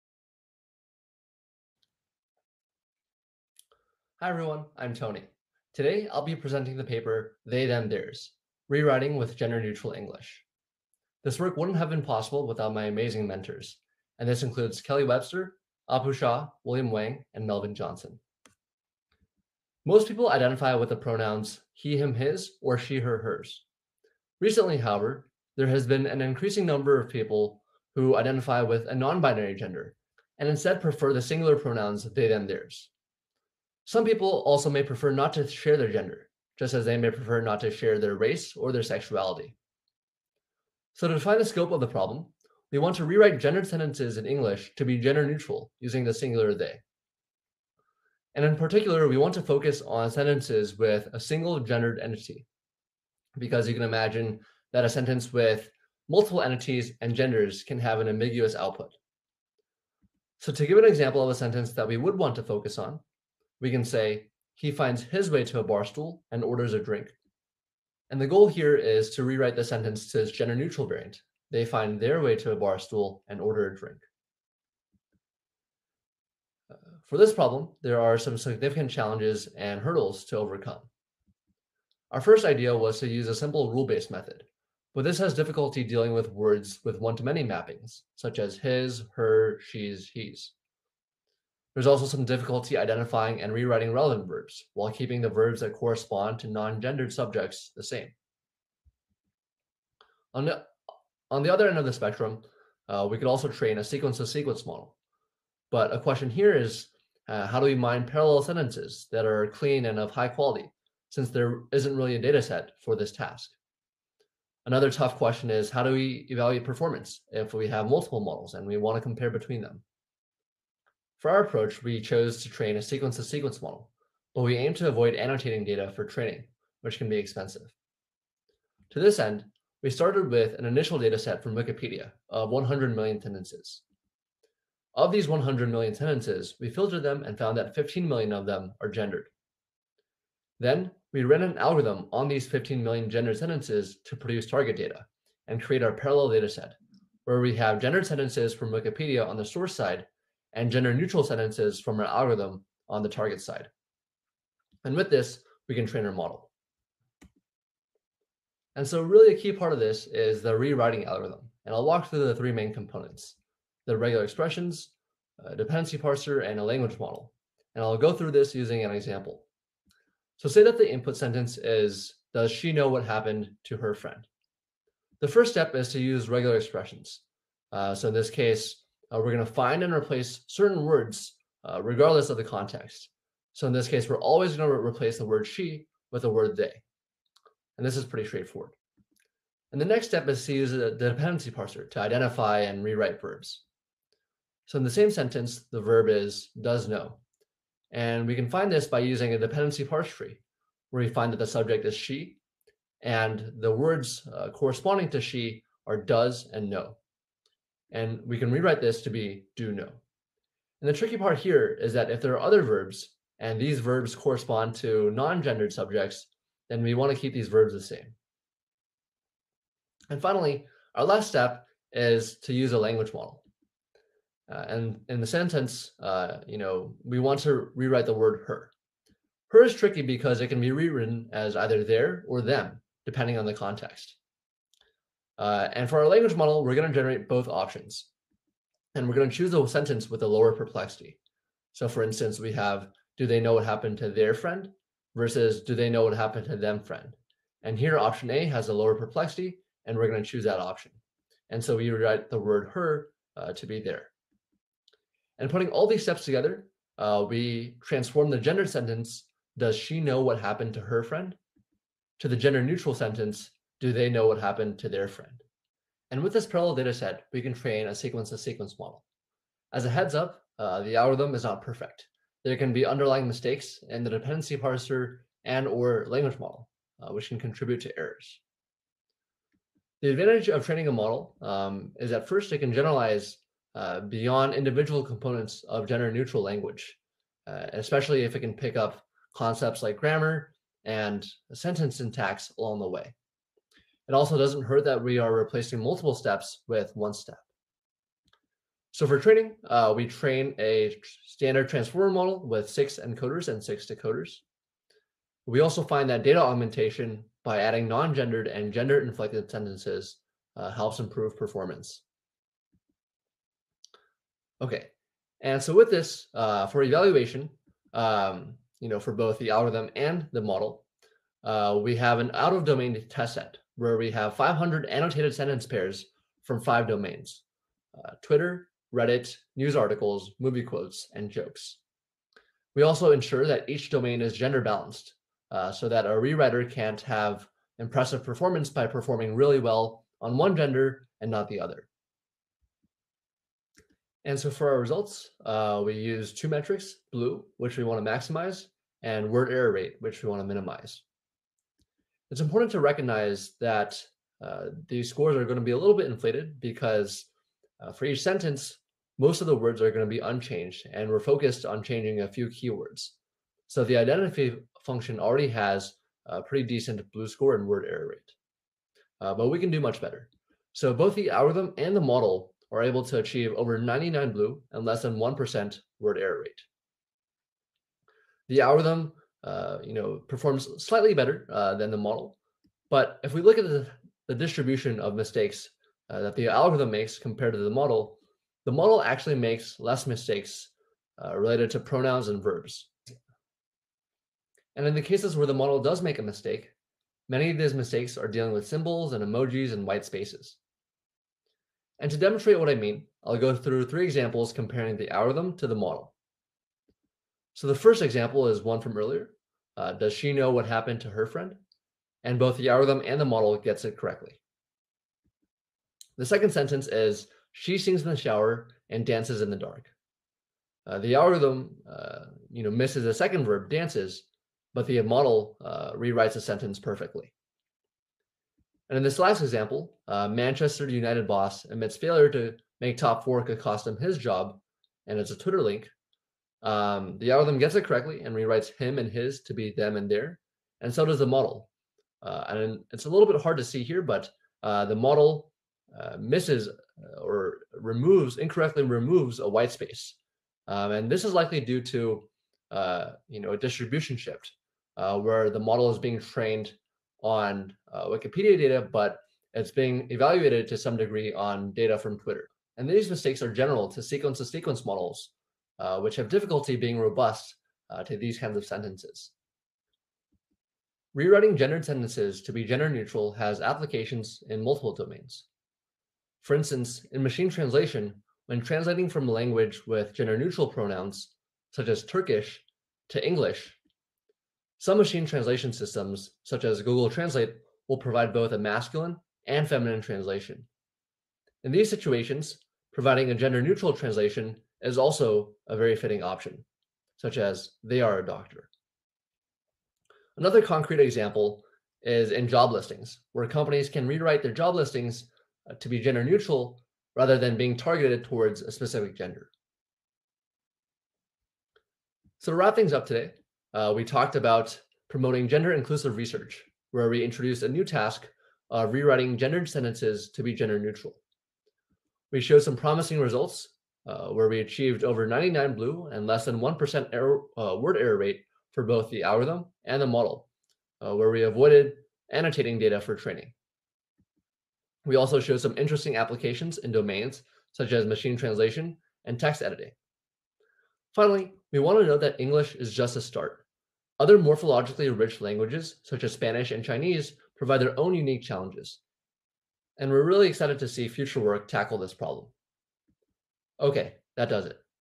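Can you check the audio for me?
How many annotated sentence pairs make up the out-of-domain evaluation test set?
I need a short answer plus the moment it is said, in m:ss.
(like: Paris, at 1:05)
500, at 5:24.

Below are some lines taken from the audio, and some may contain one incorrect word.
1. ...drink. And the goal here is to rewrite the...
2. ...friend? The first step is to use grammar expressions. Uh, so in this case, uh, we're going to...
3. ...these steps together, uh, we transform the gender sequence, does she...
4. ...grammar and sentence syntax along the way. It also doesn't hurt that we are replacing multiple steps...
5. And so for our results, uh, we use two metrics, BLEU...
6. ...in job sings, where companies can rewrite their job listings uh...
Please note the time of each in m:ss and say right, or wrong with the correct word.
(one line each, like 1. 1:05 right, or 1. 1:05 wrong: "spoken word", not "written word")
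1. 1:06 right
2. 2:53 wrong: "regular", not "grammar"
3. 4:15 wrong: "sentence", not "sequence"
4. 4:49 right
5. 5:44 right
6. 8:22 wrong: "listings", not "sings".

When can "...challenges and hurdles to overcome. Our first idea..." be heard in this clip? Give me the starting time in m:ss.
1:18.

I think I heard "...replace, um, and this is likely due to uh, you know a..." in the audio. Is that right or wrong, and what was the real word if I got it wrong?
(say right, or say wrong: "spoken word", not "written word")
wrong: "space", not "replace".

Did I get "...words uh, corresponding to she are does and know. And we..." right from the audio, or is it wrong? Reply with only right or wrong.
right.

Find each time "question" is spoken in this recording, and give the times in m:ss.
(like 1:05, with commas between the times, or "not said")
1:45, 1:55.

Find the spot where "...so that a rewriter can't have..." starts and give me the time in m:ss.
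5:35.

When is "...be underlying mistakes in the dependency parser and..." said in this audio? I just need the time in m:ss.
4:32.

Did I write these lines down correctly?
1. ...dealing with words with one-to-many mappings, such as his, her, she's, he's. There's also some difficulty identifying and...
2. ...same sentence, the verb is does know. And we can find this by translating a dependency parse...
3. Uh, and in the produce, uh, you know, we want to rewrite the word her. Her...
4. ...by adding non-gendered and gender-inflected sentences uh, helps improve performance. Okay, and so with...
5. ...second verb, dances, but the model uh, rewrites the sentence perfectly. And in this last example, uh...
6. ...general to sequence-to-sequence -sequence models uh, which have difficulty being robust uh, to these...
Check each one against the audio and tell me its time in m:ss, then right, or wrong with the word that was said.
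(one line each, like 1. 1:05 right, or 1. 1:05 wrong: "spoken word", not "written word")
1. 1:25 right
2. 3:14 wrong: "using", not "translating"
3. 3:44 wrong: "sentence", not "produce"
4. 5:07 right
5. 7:03 right
6. 7:43 right.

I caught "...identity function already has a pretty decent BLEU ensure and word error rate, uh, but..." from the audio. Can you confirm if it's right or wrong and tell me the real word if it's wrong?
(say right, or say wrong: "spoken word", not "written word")
wrong: "score", not "ensure".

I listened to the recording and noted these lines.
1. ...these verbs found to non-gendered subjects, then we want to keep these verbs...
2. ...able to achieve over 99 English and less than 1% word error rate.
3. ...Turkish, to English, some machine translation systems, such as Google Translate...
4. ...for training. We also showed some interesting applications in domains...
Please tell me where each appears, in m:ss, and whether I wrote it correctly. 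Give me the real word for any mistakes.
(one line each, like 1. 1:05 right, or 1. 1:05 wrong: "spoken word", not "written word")
1. 3:33 wrong: "correspond", not "found"
2. 6:12 wrong: "BLEU", not "English"
3. 8:02 right
4. 8:52 right.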